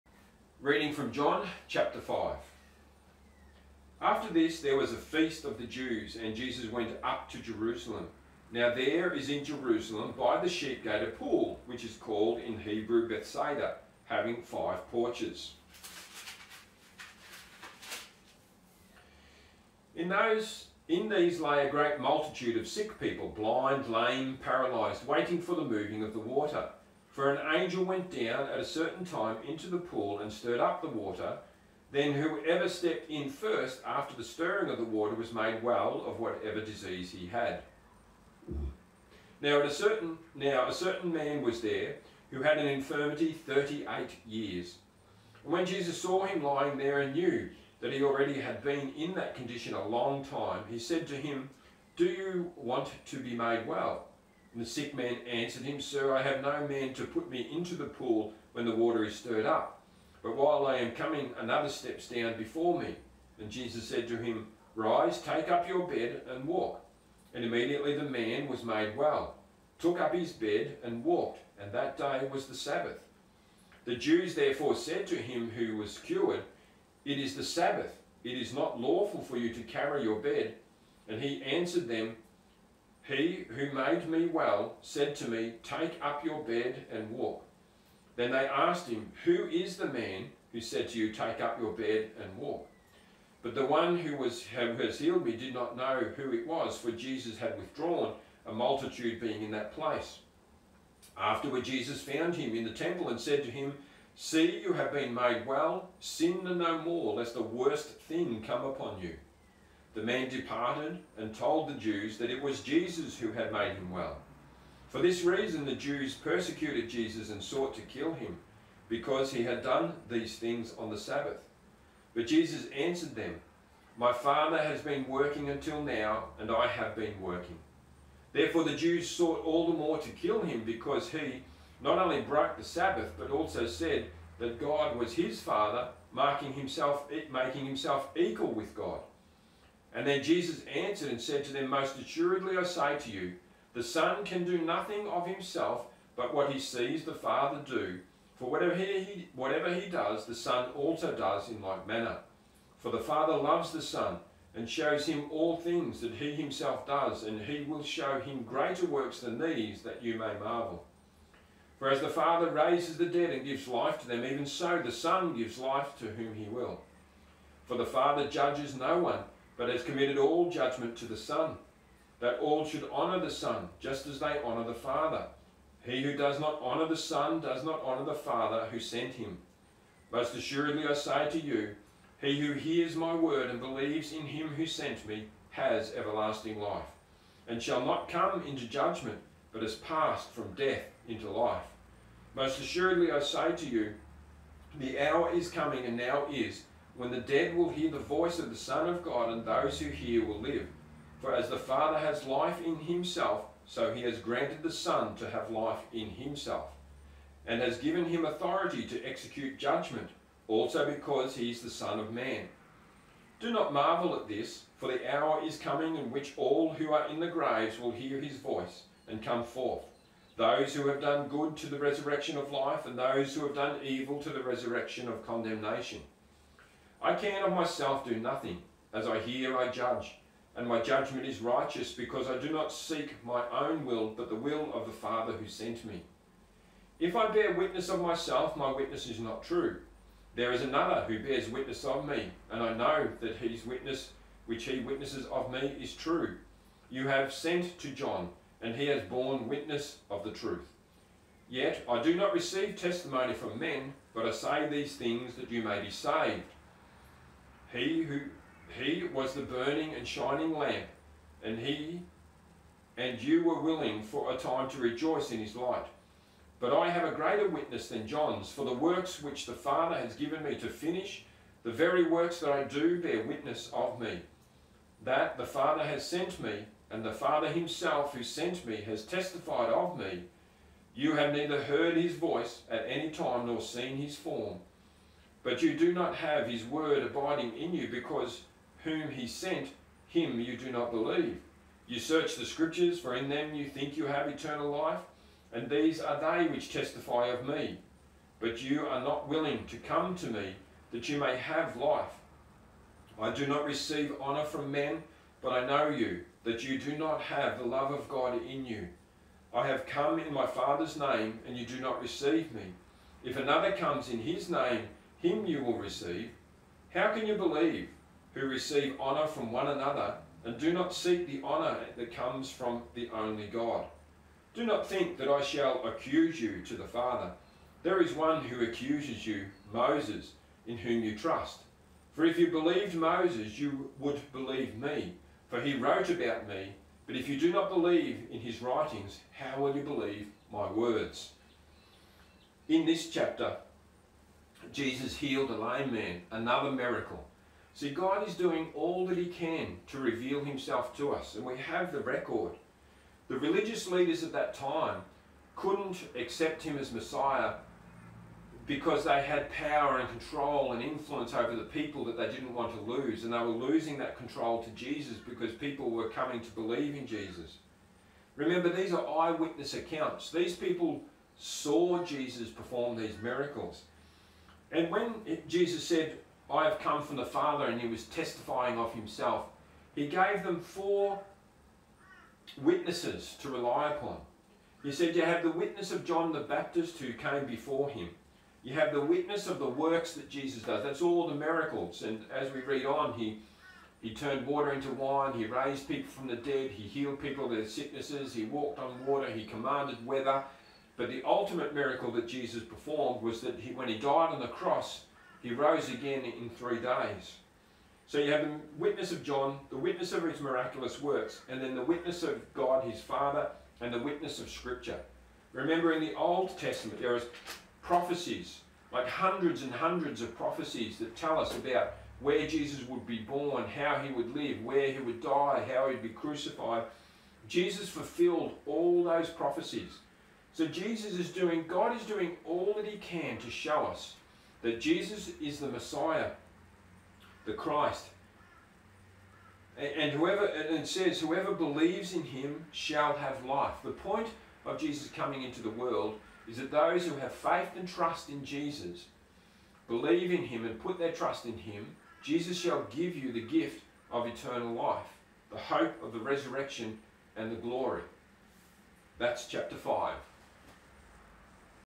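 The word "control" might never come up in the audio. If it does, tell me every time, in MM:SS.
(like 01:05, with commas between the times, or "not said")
06:00, 06:04.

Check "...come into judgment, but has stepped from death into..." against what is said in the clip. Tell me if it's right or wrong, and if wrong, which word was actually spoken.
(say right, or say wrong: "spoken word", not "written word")
wrong: "passed", not "stepped".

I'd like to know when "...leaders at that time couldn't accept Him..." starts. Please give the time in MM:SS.
05:53.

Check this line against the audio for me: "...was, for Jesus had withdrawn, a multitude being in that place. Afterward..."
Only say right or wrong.
right.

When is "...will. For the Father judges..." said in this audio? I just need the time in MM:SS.
02:46.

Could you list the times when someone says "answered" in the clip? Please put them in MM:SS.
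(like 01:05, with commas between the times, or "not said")
00:55, 01:21, 02:02, 02:20.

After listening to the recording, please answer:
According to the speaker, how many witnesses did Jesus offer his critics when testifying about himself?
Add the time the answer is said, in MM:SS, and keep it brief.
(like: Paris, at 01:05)
4, at 06:20.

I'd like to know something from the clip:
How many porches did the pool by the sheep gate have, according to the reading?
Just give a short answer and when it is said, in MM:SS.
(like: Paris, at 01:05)
5, at 00:14.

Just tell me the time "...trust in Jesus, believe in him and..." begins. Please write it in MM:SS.
07:27.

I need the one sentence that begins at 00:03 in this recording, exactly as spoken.
After this, there was a feast of the Jews, and Jesus went up to Jerusalem.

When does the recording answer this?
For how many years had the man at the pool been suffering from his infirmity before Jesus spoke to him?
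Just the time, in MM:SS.
00:43.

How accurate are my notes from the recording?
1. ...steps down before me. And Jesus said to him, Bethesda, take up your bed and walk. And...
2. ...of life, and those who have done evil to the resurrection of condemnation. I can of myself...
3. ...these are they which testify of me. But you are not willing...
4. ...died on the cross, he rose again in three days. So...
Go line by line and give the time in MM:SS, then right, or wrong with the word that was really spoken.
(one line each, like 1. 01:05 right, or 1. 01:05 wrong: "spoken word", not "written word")
1. 01:01 wrong: "Rise", not "Bethesda"
2. 03:42 right
3. 04:55 right
4. 06:43 right.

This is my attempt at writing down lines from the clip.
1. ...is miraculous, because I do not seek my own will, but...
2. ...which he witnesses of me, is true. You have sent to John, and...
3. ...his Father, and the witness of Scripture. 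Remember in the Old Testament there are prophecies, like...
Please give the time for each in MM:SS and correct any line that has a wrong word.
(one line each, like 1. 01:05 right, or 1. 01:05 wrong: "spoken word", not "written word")
1. 03:51 wrong: "righteous", not "miraculous"
2. 04:04 right
3. 06:52 right.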